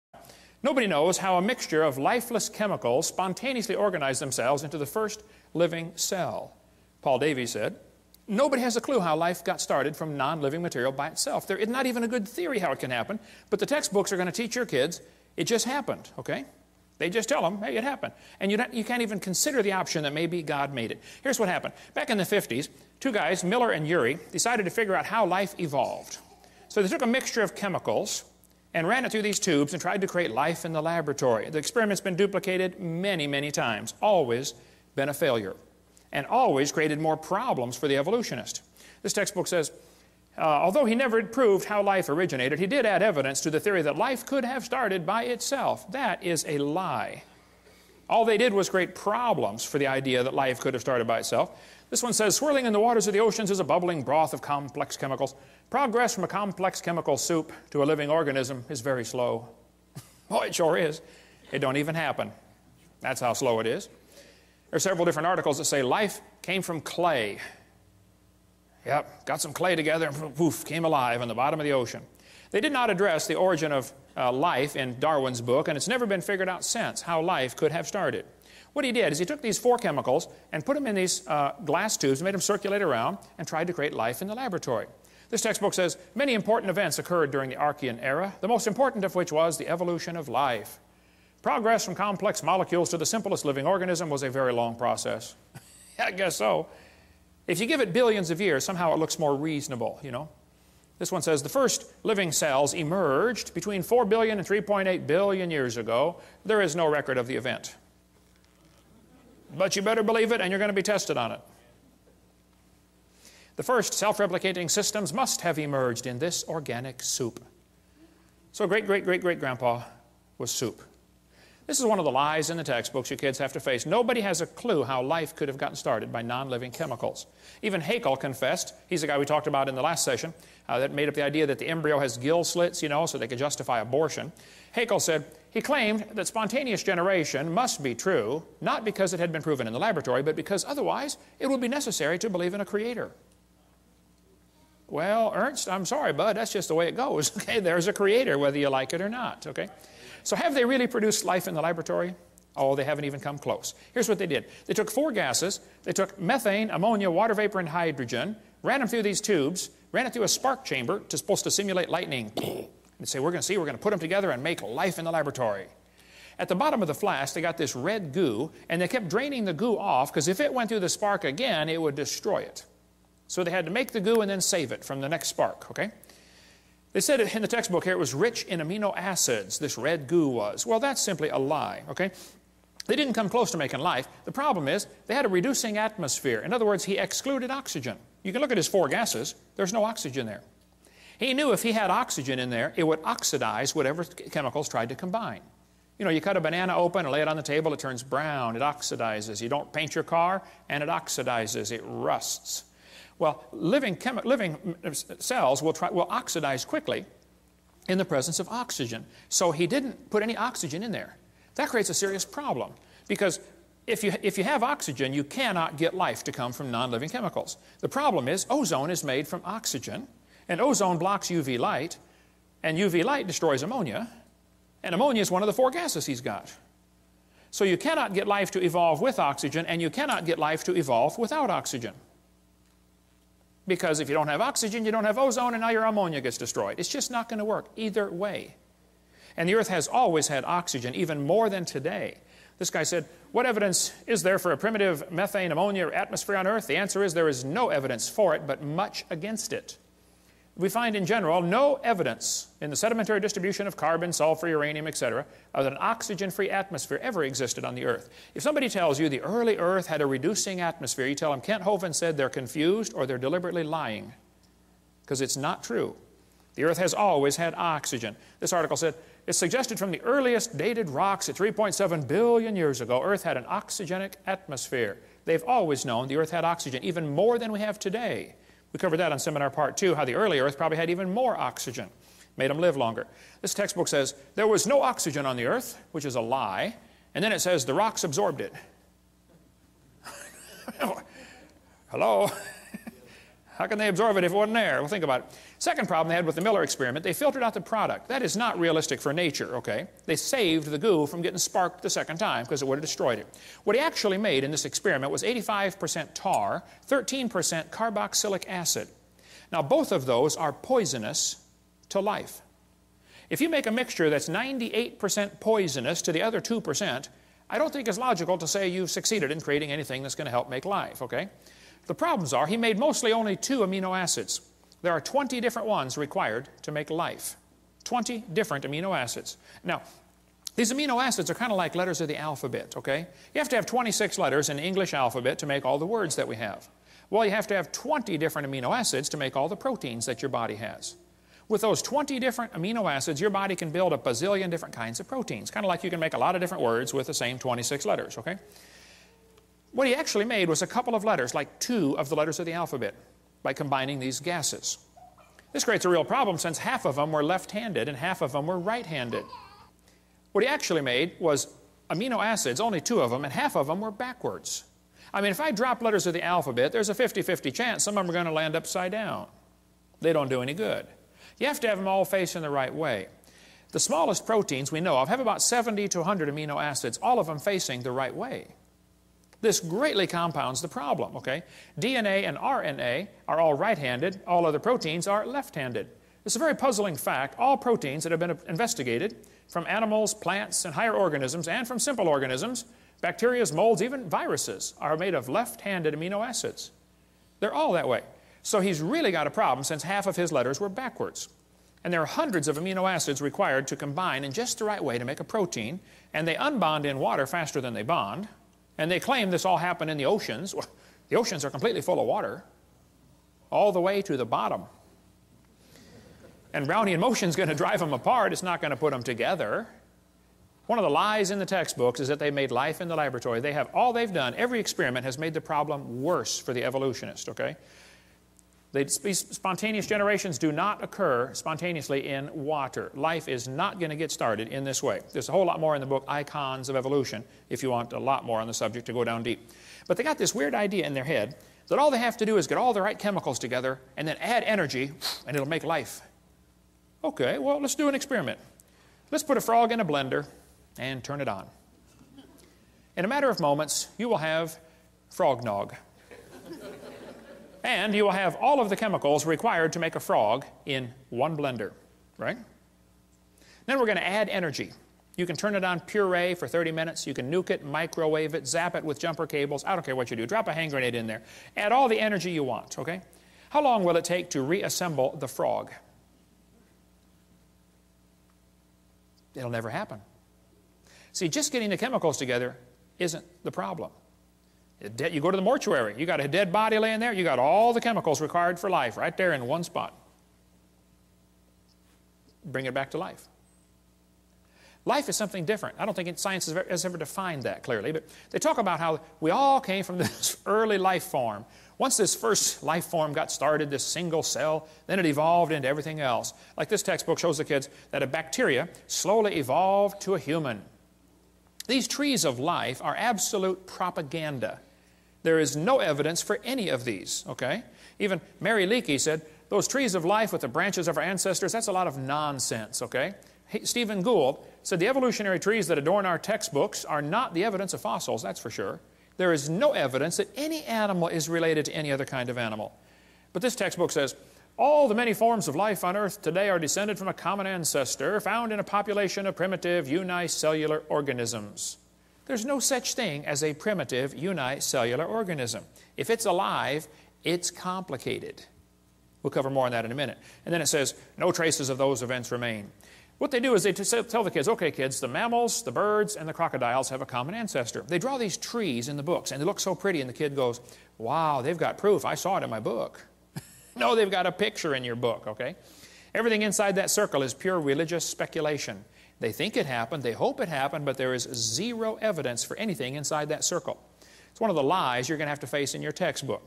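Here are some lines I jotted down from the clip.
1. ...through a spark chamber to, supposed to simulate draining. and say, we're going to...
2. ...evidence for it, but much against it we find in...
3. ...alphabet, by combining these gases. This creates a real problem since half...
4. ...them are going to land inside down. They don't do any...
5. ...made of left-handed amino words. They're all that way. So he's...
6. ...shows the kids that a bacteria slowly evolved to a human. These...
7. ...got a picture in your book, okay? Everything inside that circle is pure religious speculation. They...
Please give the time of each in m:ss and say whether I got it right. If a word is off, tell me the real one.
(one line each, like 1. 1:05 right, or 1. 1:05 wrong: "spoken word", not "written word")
1. 2:40 wrong: "lightning", not "draining"
2. 4:07 right
3. 5:52 right
4. 6:08 wrong: "upside", not "inside"
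5. 6:34 wrong: "acids", not "words"
6. 8:27 right
7. 9:24 right.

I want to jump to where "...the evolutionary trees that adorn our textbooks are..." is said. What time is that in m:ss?
8:44.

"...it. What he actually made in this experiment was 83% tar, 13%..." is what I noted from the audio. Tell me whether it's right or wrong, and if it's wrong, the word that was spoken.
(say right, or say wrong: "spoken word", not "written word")
wrong: "85", not "83".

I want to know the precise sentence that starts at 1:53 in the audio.
The first self replicating systems must have emerged in this organic soup.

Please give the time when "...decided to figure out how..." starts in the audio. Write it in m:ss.
0:24.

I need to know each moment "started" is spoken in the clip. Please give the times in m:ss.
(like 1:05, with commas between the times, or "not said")
0:09, 0:44, 0:50, 1:17, 2:05, 7:14, 8:23.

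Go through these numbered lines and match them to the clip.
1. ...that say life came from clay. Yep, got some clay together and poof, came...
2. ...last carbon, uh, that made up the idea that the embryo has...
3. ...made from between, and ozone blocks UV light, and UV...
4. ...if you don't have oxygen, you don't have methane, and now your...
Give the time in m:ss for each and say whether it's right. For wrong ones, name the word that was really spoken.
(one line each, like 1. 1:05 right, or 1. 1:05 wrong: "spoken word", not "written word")
1. 1:05 right
2. 2:09 wrong: "session", not "carbon"
3. 3:39 wrong: "oxygen", not "between"
4. 3:53 wrong: "ozone", not "methane".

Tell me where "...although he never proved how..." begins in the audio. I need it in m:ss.
0:40.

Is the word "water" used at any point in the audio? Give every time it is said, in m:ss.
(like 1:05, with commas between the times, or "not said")
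0:52, 2:37, 6:46, 6:52, 7:12.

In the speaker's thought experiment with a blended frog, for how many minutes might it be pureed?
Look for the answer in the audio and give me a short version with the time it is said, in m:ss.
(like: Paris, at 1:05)
30, at 7:46.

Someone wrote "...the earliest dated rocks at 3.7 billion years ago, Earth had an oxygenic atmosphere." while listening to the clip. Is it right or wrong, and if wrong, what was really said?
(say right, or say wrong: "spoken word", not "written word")
right.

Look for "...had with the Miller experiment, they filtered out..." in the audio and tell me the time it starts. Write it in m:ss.
4:56.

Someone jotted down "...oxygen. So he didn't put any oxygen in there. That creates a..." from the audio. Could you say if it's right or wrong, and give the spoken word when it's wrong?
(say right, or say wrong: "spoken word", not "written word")
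right.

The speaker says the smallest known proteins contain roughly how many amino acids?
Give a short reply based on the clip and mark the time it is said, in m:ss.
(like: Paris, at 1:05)
70 to 100, at 6:15.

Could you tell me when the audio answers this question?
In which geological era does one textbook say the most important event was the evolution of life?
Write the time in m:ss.
1:27.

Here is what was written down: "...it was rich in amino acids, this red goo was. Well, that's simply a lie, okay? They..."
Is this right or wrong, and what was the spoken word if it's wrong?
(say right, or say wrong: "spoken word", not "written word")
right.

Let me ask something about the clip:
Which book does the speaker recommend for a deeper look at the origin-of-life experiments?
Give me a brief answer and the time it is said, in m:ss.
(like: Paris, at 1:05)
Icons of Evolution, at 7:16.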